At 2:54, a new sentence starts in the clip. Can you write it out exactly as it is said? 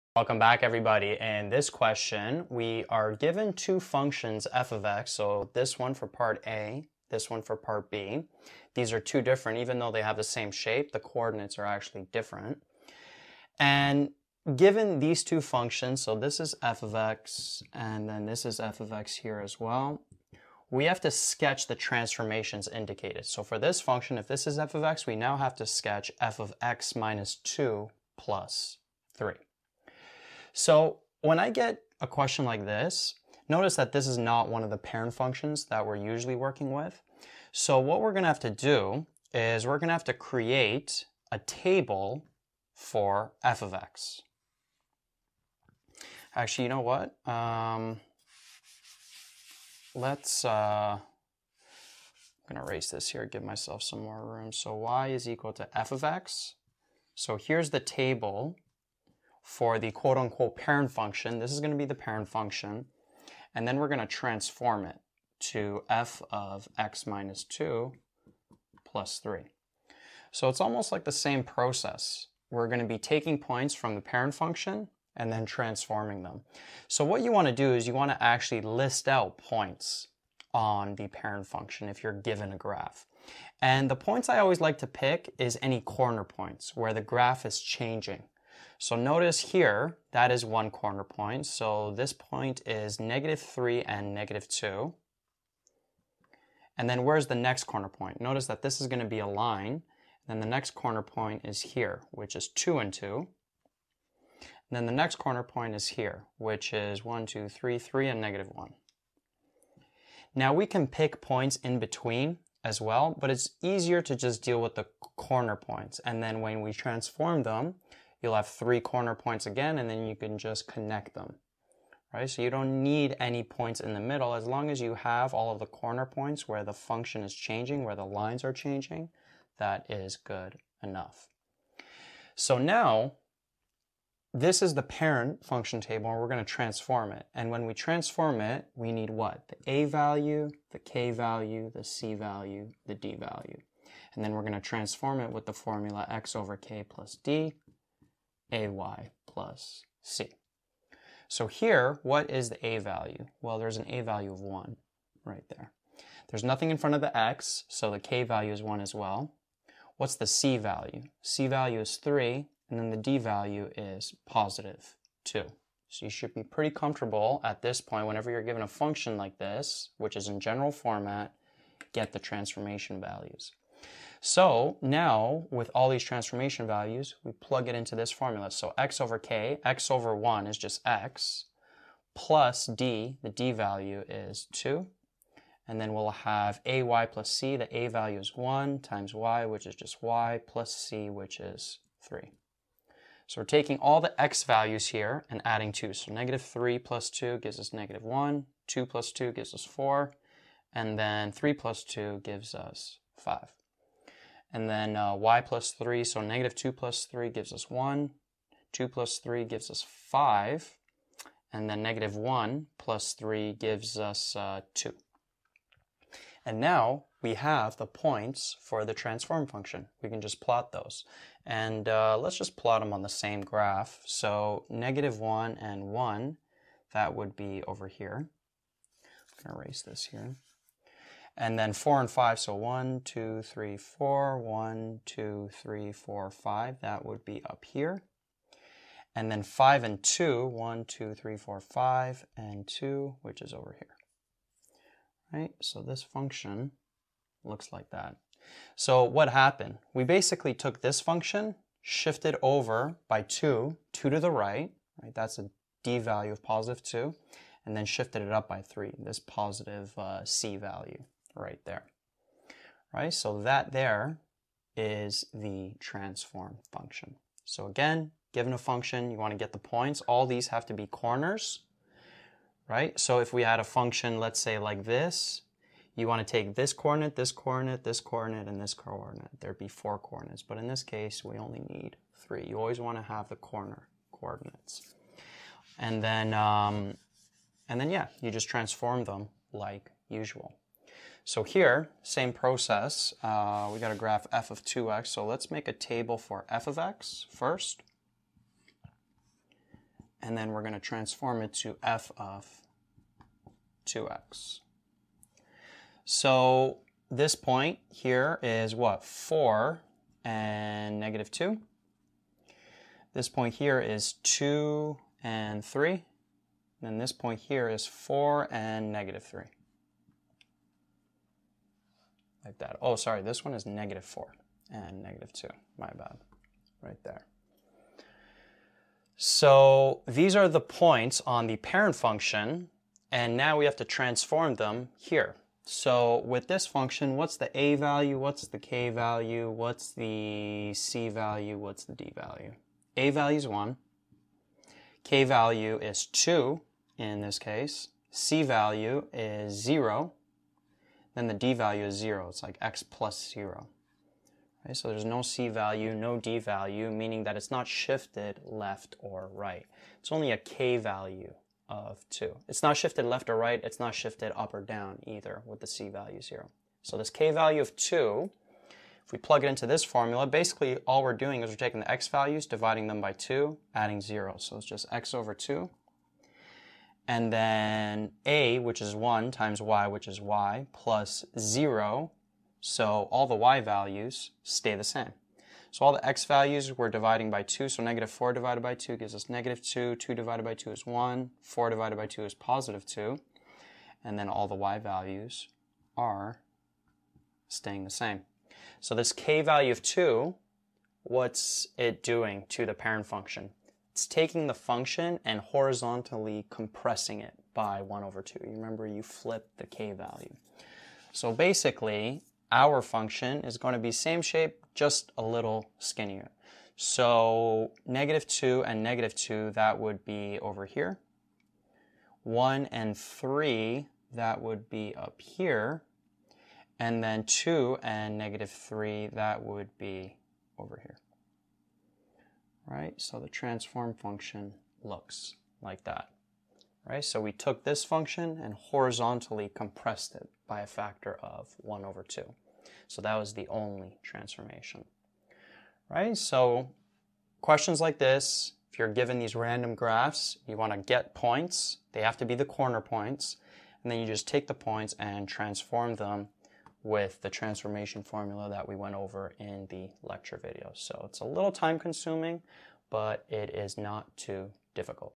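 So now with all these transformation values, we plug it into this formula.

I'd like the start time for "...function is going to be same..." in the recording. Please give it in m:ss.
6:52.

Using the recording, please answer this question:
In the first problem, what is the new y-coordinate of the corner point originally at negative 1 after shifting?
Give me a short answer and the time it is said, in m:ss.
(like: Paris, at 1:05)
2, at 3:33.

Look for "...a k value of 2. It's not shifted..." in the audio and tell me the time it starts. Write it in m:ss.
6:00.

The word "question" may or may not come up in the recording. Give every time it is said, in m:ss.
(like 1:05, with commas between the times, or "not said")
0:01, 0:32, 7:27.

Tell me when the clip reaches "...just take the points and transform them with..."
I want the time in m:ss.
7:34.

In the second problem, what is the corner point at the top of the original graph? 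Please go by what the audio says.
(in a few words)
(2, 3).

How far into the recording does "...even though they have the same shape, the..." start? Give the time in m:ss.
0:09.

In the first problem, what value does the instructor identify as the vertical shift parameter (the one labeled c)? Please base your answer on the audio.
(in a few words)
3.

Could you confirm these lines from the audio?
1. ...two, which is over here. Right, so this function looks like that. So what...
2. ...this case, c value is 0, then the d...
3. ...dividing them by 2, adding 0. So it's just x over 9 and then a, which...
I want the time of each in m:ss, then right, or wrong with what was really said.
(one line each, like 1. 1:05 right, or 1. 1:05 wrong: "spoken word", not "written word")
1. 4:02 right
2. 5:47 right
3. 6:12 wrong: "2", not "9".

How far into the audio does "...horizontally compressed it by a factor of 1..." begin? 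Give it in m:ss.
7:18.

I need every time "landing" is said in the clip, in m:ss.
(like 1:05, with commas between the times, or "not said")
not said.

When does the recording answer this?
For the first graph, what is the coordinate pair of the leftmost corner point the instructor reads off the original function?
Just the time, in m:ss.
1:32.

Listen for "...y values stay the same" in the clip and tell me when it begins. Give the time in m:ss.
6:23.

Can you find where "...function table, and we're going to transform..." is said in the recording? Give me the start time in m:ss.
2:15.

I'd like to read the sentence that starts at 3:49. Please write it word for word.
I'm going to erase this here and then four and five.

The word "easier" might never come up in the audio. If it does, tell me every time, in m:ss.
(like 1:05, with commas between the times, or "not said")
1:53.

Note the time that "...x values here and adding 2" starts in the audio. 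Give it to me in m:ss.
3:14.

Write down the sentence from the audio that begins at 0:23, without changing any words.
So for this function, if this is f of x, we now have to sketch f of x minus 2 plus 3.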